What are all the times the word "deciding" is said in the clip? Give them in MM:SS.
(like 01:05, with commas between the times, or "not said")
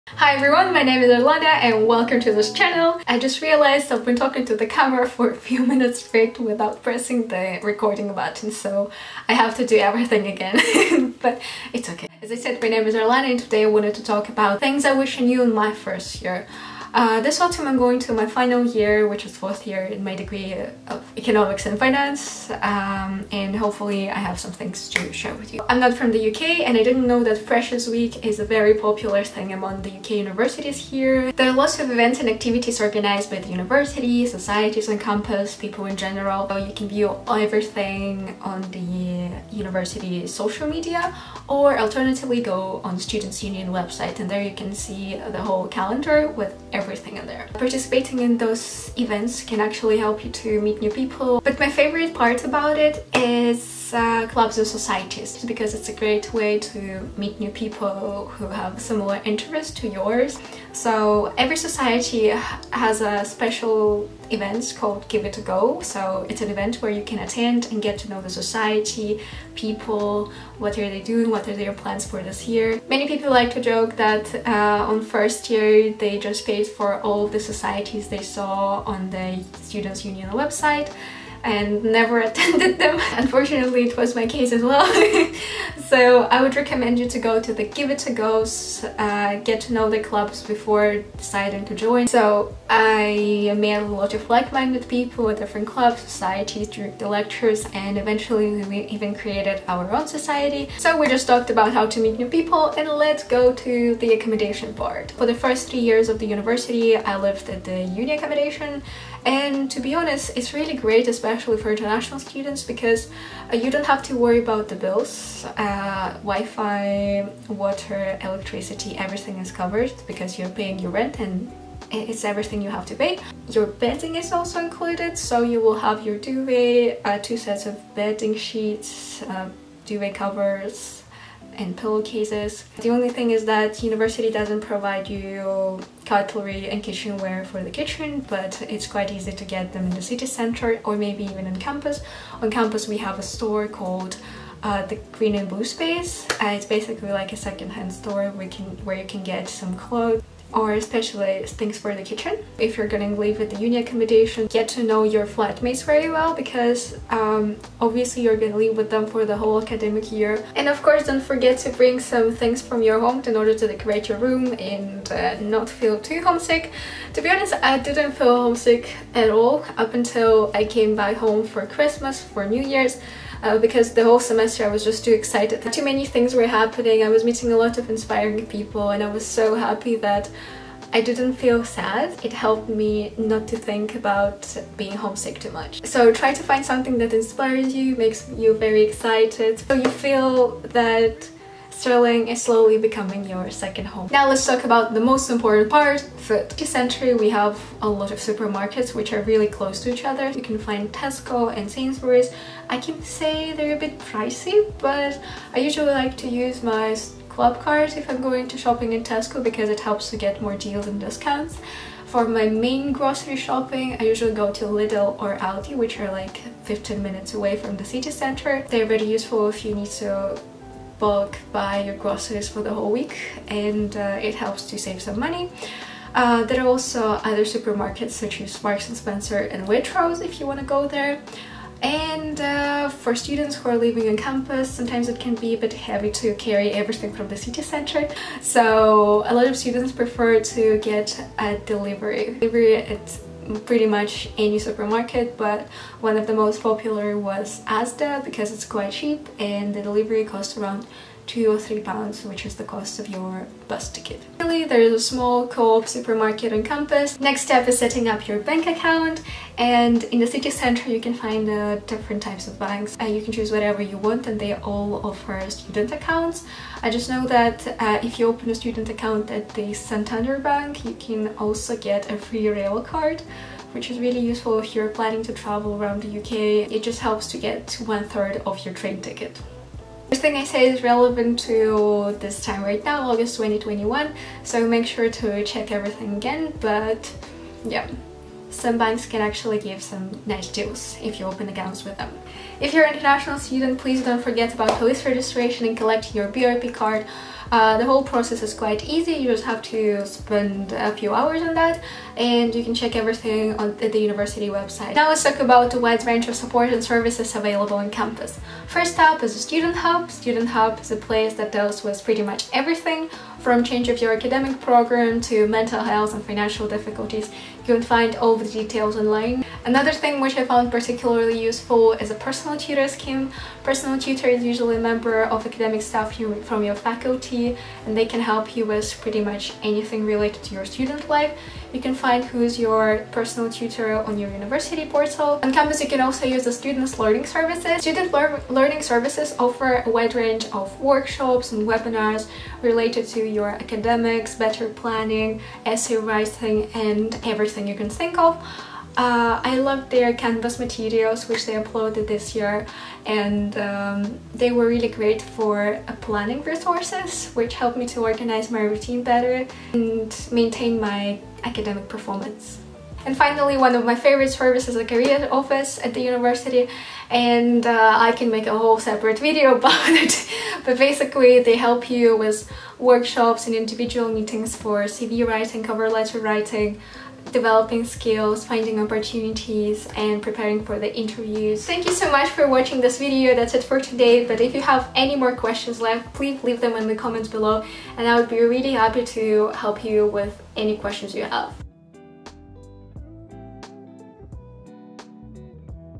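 01:31.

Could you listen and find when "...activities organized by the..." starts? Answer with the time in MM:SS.
00:32.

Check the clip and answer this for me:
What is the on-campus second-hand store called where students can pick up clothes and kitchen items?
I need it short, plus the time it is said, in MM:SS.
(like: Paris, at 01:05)
the Green and Blue Space, at 02:24.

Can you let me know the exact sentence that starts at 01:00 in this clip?
So every society has a special event called Give It A Go.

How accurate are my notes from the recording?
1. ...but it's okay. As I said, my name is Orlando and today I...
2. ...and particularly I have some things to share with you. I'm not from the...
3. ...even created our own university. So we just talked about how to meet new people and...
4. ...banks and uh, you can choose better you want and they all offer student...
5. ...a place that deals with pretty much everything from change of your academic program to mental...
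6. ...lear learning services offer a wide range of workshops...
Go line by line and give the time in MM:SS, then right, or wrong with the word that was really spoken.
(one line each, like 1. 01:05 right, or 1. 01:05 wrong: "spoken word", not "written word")
1. 00:11 right
2. 00:23 wrong: "hopefully", not "particularly"
3. 01:38 wrong: "society", not "university"
4. 04:22 wrong: "whatever", not "better"
5. 05:10 right
6. 05:38 right.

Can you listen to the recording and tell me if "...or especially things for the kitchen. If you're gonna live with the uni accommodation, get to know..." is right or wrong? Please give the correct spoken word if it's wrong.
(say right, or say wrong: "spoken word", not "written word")
right.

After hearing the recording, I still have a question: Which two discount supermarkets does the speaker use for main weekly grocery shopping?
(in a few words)
Lidl or Aldi.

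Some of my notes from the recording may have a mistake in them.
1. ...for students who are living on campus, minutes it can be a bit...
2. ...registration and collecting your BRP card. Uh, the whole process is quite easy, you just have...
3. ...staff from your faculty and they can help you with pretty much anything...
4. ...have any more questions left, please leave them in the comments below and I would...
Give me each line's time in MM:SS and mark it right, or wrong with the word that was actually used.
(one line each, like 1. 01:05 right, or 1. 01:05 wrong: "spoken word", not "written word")
1. 03:52 wrong: "sometimes", not "minutes"
2. 04:55 right
3. 05:25 right
4. 06:24 right.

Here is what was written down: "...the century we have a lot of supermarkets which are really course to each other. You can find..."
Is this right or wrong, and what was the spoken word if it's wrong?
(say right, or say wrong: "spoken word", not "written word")
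wrong: "close", not "course".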